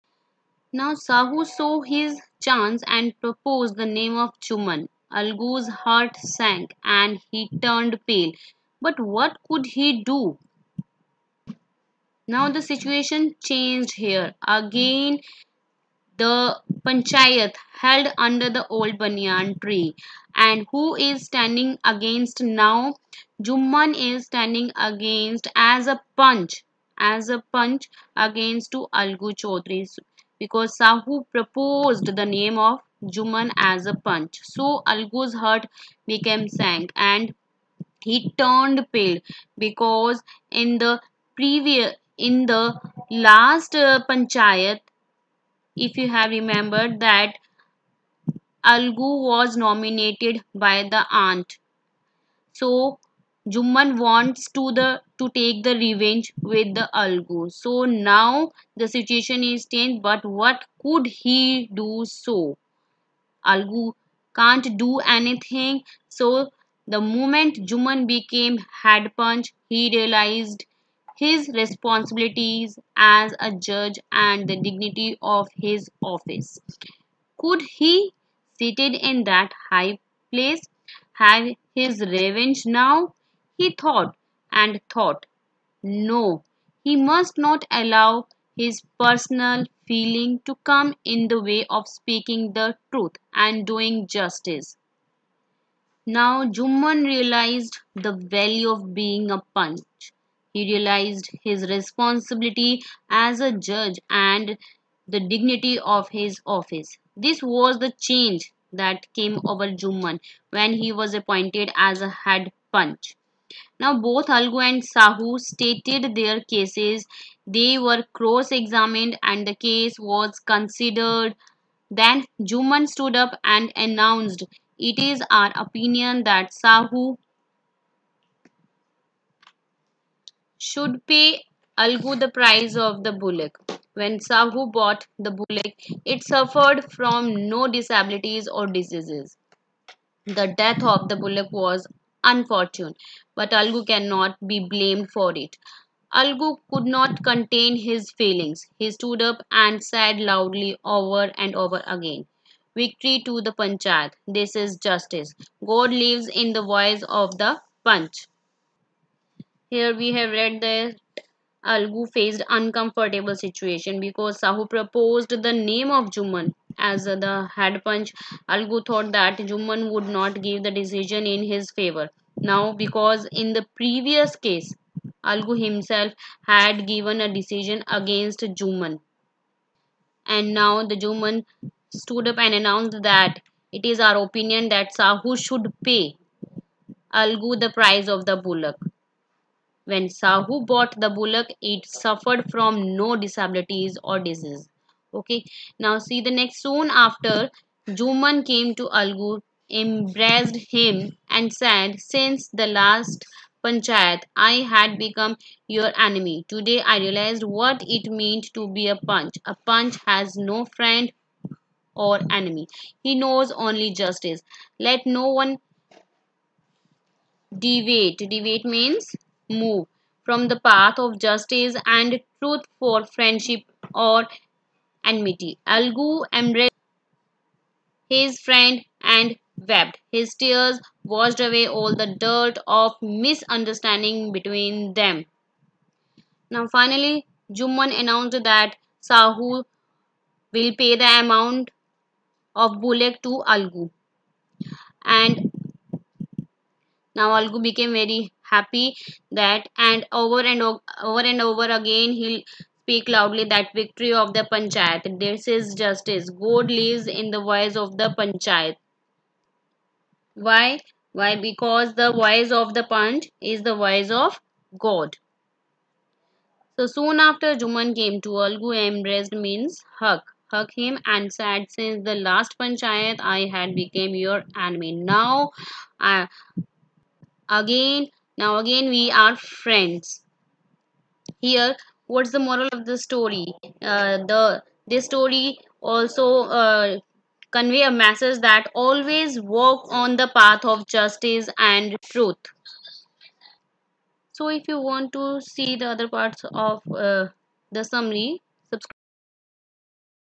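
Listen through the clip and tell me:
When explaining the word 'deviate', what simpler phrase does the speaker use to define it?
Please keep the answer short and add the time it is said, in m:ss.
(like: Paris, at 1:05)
Move from, at 3:39.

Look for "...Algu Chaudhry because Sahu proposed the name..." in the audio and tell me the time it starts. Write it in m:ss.
0:28.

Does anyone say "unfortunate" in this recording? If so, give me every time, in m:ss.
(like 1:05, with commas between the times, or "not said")
2:22.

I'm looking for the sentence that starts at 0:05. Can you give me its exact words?
Algu's heart sank and he turned pale.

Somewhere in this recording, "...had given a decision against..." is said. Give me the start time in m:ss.
2:56.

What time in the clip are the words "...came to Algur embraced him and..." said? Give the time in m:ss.
3:18.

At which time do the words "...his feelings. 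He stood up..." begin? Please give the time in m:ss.
2:27.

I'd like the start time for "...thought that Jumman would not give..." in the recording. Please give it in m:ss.
2:48.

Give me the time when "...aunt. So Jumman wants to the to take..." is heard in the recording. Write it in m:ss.
0:51.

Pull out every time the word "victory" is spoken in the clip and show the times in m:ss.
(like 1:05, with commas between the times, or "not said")
2:32, 4:13.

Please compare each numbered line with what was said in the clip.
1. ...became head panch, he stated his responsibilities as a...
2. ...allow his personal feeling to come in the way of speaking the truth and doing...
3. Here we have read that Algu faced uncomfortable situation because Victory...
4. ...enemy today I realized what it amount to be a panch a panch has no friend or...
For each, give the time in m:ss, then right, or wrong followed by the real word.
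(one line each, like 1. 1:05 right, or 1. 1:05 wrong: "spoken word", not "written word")
1. 1:08 wrong: "realized", not "stated"
2. 1:27 right
3. 2:39 wrong: "Sahu", not "Victory"
4. 3:26 wrong: "meant", not "amount".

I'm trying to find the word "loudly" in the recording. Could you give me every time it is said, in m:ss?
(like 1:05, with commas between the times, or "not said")
2:30, 4:13.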